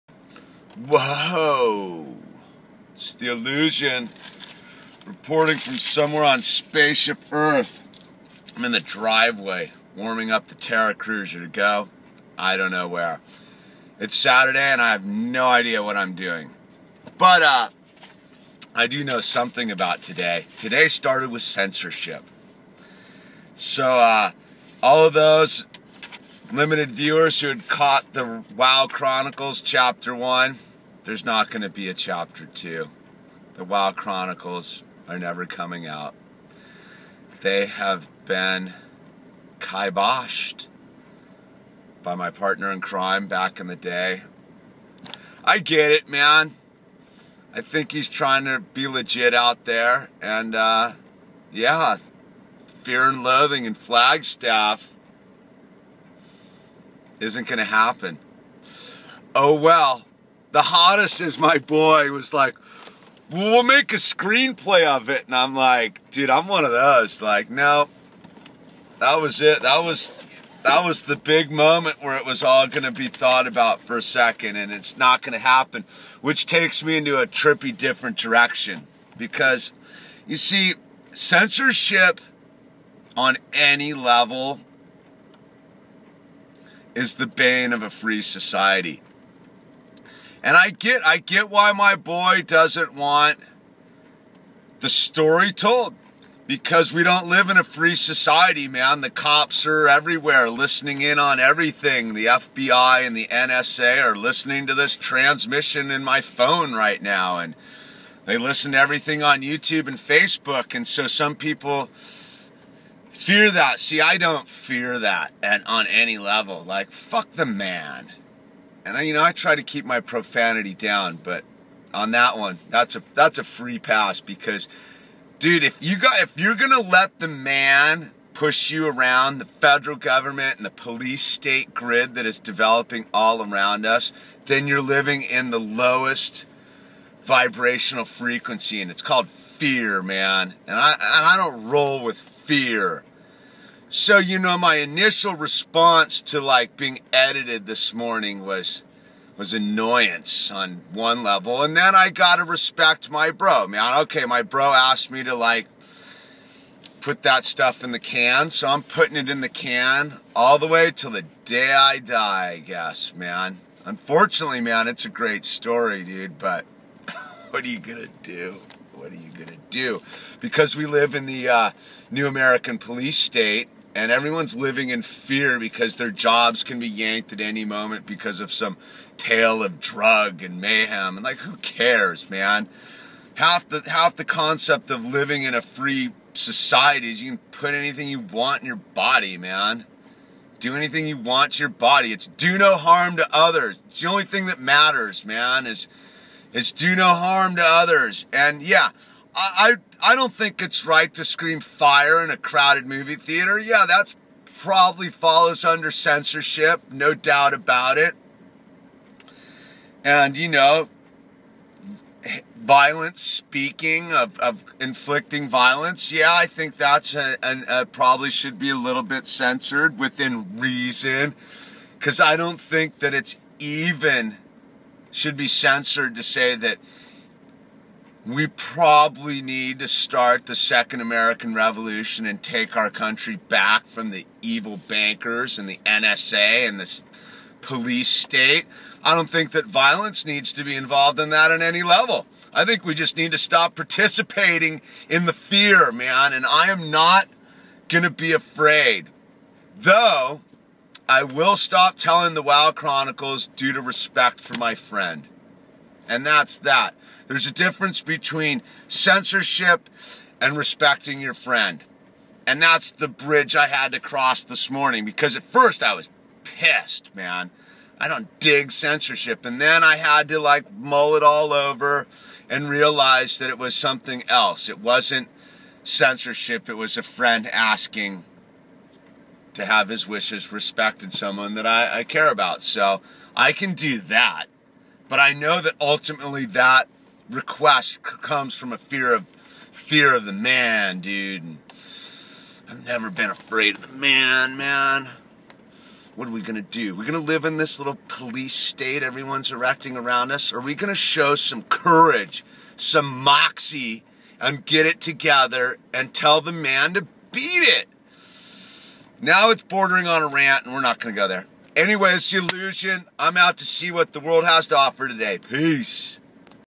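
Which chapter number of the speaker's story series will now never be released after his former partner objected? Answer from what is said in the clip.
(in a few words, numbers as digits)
Chapter 2.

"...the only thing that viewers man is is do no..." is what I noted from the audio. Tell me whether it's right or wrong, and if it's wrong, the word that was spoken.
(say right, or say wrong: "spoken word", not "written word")
wrong: "matters", not "viewers".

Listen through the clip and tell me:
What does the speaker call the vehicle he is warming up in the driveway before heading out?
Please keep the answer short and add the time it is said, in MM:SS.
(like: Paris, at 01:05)
Terra Cruiser, at 00:10.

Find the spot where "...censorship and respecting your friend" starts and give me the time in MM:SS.
04:18.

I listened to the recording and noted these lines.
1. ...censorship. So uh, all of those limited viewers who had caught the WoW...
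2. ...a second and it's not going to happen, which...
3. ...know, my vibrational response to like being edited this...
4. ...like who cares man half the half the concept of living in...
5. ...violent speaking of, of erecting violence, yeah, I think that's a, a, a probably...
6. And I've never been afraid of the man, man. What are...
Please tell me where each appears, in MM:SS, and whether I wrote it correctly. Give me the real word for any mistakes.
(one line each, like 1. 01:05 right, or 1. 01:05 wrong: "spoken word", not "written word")
1. 00:21 right
2. 01:13 right
3. 02:24 wrong: "initial", not "vibrational"
4. 03:01 right
5. 03:32 wrong: "inflicting", not "erecting"
6. 04:51 right.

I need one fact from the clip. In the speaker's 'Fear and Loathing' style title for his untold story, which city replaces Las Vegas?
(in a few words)
Flagstaff.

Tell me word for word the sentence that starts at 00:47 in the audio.
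I think he's trying to be legit out there.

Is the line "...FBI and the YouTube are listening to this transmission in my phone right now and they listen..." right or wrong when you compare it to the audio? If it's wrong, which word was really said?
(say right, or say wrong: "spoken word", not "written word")
wrong: "NSA", not "YouTube".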